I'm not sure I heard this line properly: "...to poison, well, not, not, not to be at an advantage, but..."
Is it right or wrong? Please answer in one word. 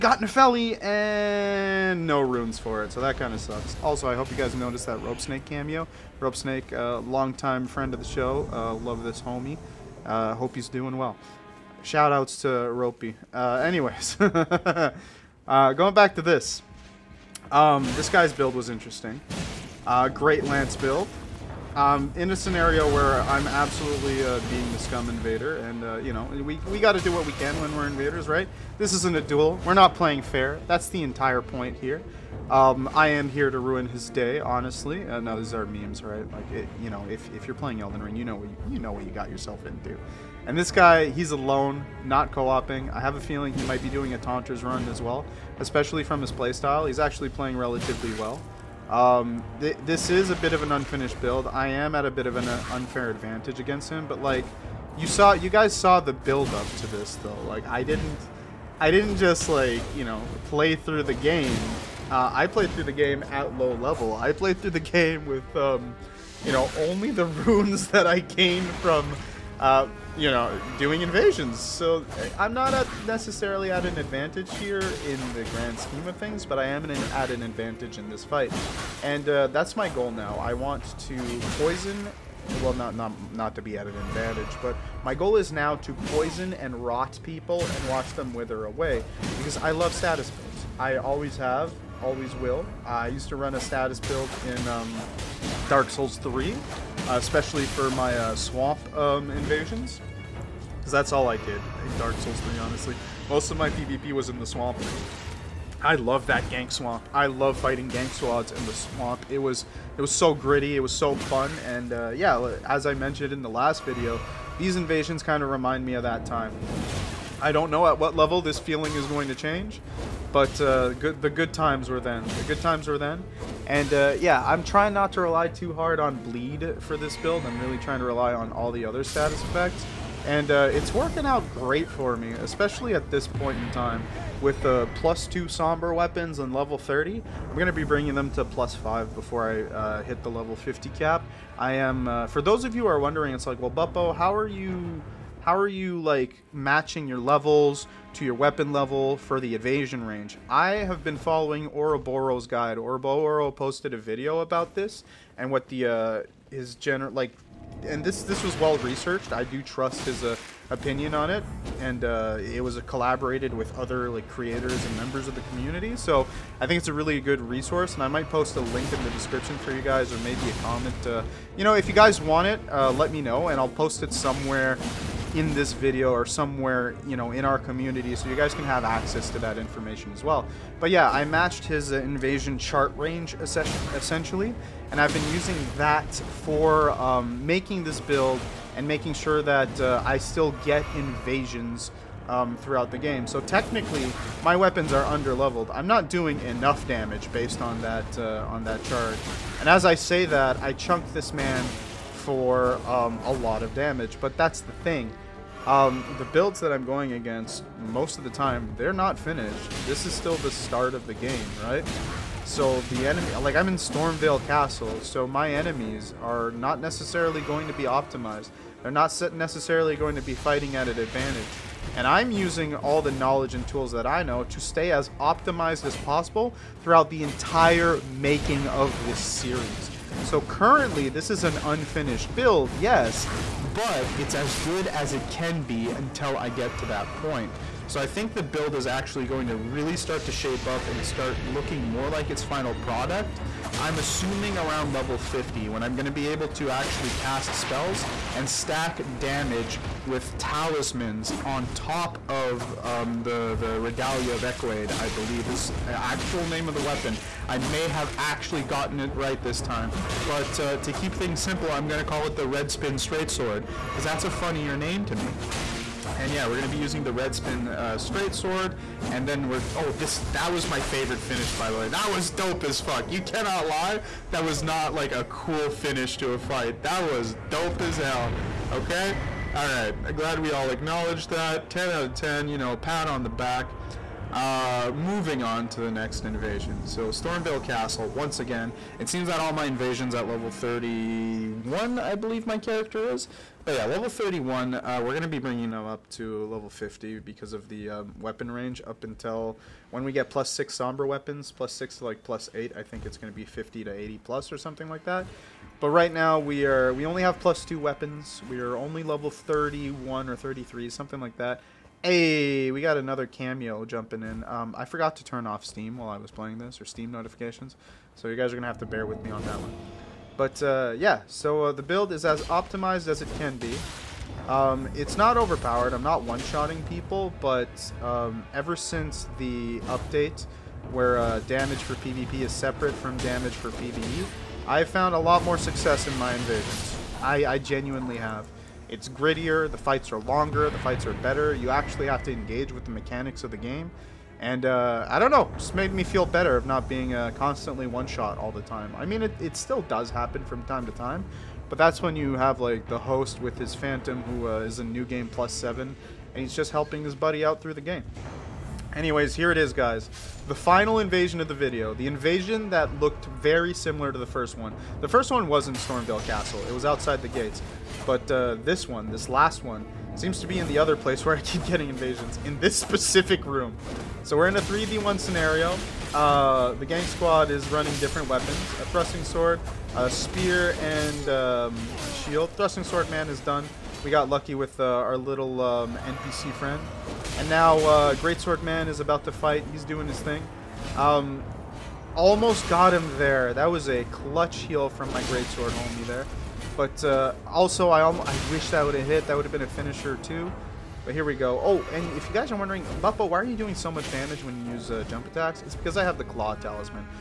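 right.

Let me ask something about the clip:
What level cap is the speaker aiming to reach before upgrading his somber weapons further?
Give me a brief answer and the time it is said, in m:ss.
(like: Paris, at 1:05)
50, at 2:20.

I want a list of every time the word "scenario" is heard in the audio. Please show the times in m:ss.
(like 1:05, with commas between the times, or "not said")
0:22, 6:15.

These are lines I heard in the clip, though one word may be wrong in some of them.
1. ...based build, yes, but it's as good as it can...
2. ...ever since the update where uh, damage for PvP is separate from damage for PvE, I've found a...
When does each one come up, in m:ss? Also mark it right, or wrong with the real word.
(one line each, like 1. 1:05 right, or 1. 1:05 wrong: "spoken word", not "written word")
1. 3:51 wrong: "unfinished", not "based"
2. 5:28 right.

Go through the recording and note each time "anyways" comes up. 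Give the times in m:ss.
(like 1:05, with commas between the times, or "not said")
0:13, 5:58.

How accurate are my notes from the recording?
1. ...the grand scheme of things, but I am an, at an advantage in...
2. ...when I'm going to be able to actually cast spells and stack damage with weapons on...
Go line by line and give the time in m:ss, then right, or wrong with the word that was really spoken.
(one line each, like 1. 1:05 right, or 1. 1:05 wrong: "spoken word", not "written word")
1. 1:15 right
2. 4:05 wrong: "talismans", not "weapons".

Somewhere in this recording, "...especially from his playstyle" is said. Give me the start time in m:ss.
0:45.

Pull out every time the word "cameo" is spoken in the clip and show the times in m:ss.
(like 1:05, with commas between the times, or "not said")
0:05, 5:13.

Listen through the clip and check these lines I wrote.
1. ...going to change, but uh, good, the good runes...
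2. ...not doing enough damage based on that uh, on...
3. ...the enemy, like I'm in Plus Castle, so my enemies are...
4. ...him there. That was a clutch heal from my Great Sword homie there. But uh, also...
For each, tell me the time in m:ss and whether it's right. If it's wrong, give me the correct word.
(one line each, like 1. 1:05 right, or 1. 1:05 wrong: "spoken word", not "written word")
1. 1:59 wrong: "times", not "runes"
2. 3:15 right
3. 3:32 wrong: "Stormveil", not "Plus"
4. 6:32 right.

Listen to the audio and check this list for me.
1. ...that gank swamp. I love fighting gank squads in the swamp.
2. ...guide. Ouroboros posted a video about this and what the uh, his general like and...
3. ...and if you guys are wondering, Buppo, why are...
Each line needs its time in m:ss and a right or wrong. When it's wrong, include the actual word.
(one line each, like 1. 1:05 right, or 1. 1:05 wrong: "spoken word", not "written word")
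1. 1:46 right
2. 2:32 right
3. 6:41 right.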